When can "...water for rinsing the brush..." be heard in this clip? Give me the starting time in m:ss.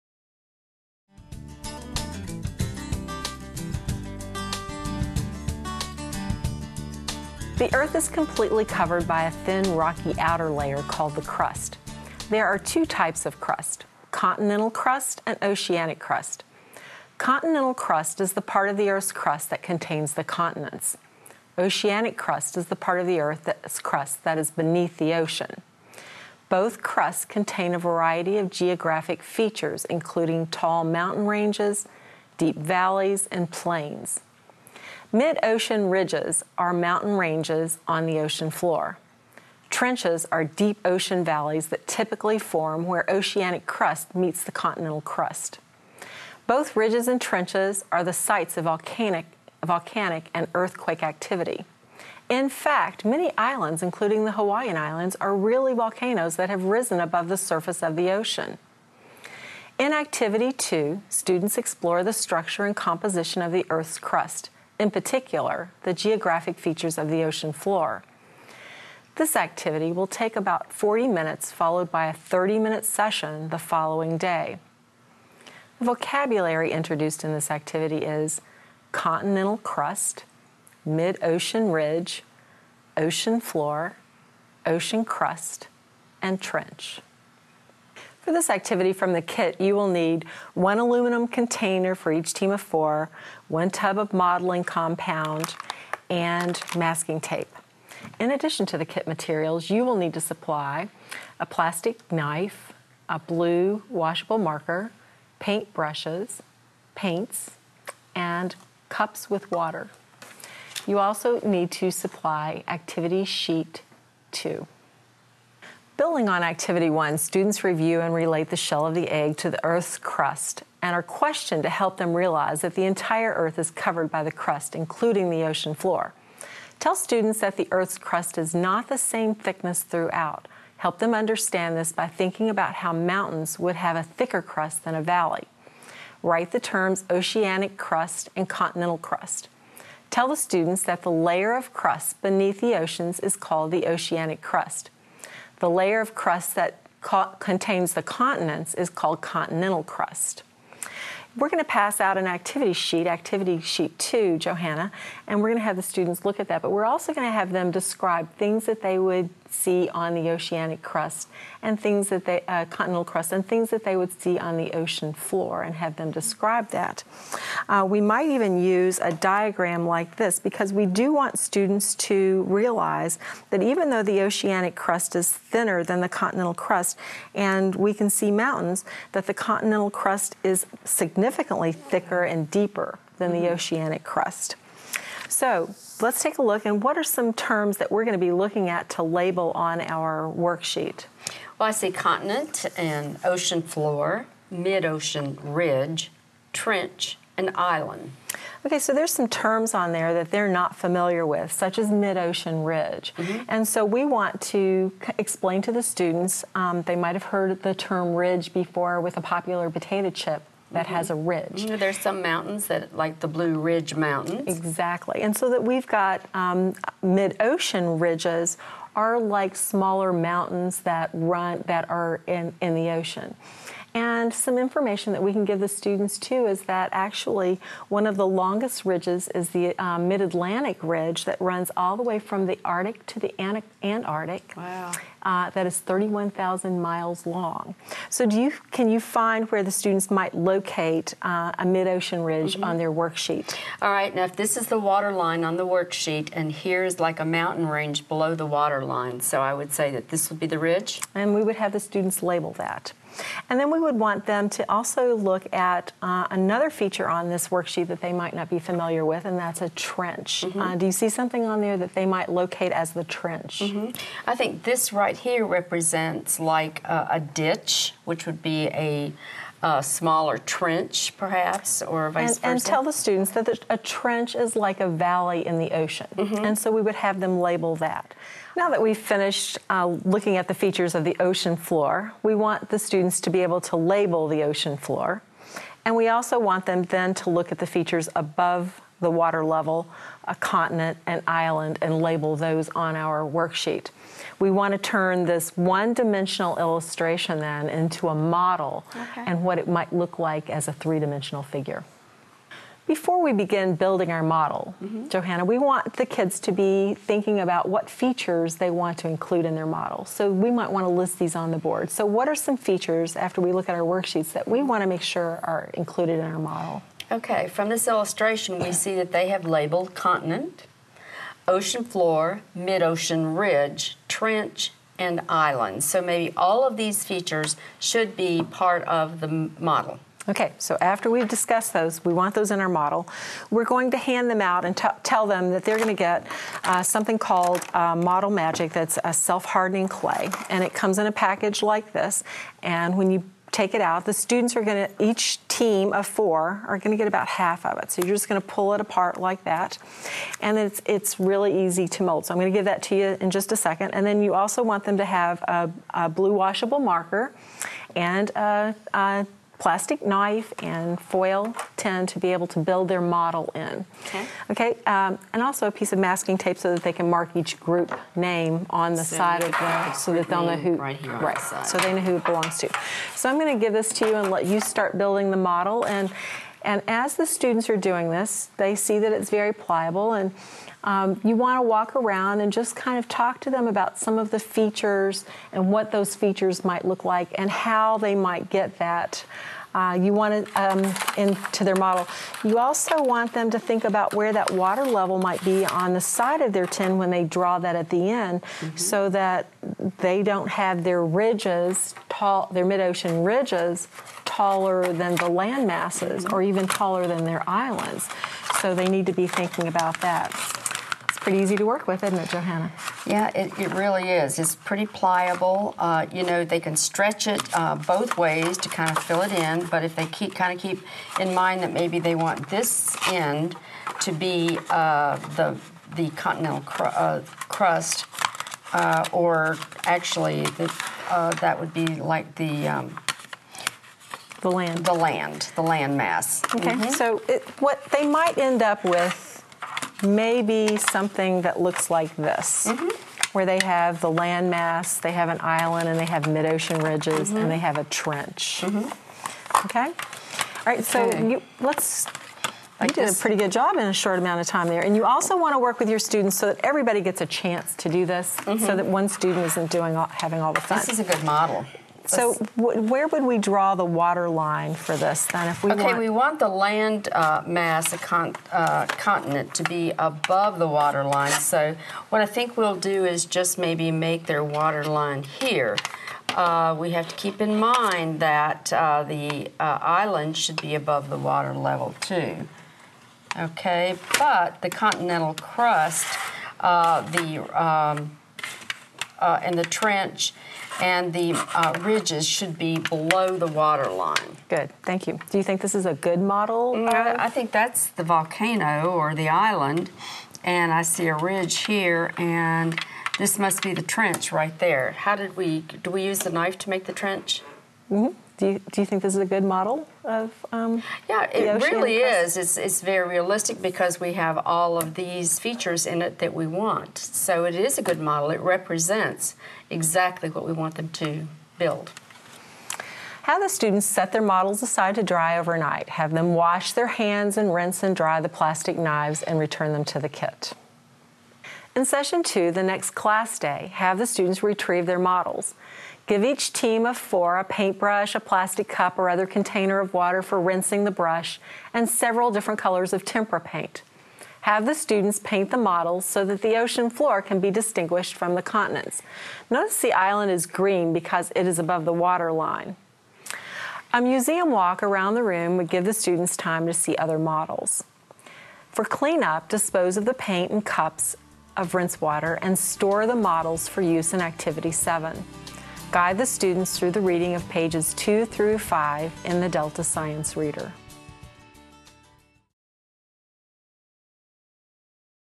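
8:59.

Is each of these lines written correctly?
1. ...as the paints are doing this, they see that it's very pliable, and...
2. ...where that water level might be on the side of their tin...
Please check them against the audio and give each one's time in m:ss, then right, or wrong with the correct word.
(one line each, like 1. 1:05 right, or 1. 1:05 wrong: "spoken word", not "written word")
1. 6:16 wrong: "students", not "paints"
2. 6:34 right.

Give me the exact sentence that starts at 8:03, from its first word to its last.
Okay, but the continental crust, uh, the um, uh, and the trench and the uh, ridges should be below the water line.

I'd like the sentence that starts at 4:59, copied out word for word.
and what it might look like as a three-dimensional figure.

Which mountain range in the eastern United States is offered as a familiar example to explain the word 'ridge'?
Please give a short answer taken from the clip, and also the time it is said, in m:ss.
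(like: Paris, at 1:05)
Blue Ridge Mountains, at 3:33.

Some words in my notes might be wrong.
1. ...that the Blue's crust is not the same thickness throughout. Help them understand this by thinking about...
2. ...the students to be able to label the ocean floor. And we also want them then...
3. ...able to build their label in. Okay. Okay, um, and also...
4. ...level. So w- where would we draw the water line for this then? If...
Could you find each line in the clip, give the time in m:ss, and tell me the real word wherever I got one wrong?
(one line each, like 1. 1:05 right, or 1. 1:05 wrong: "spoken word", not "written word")
1. 2:07 wrong: "Earth", not "Blue"
2. 4:42 right
3. 6:02 wrong: "model", not "label"
4. 7:41 wrong: "model", not "level".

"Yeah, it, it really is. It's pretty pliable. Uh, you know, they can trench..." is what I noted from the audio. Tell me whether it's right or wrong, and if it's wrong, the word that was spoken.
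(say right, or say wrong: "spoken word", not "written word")
wrong: "stretch", not "trench".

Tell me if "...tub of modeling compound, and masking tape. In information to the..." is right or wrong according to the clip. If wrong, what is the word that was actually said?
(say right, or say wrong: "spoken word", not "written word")
wrong: "addition", not "information".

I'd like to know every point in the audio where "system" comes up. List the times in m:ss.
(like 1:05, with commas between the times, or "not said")
not said.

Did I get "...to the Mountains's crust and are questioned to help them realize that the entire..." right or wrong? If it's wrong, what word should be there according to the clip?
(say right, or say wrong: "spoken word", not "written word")
wrong: "Earth", not "Mountains".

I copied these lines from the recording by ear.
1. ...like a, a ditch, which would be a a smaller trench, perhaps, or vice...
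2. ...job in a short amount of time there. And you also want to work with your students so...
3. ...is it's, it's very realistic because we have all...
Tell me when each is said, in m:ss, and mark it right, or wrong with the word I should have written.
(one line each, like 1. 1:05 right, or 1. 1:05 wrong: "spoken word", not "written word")
1. 4:26 right
2. 7:33 right
3. 8:31 right.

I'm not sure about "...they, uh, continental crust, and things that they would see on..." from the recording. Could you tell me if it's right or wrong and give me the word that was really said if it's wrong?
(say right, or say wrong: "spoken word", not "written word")
right.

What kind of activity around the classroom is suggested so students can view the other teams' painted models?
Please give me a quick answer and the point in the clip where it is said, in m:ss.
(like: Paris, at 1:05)
museum walk, at 9:14.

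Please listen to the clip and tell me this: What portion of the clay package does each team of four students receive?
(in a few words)
half.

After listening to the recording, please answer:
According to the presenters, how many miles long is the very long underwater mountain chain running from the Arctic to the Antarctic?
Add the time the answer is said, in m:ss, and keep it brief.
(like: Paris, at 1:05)
31,000, at 3:55.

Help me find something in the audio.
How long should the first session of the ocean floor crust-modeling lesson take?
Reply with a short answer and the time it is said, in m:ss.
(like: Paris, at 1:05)
40 minutes, at 1:10.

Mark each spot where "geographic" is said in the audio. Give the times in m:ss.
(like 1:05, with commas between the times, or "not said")
0:28, 1:05.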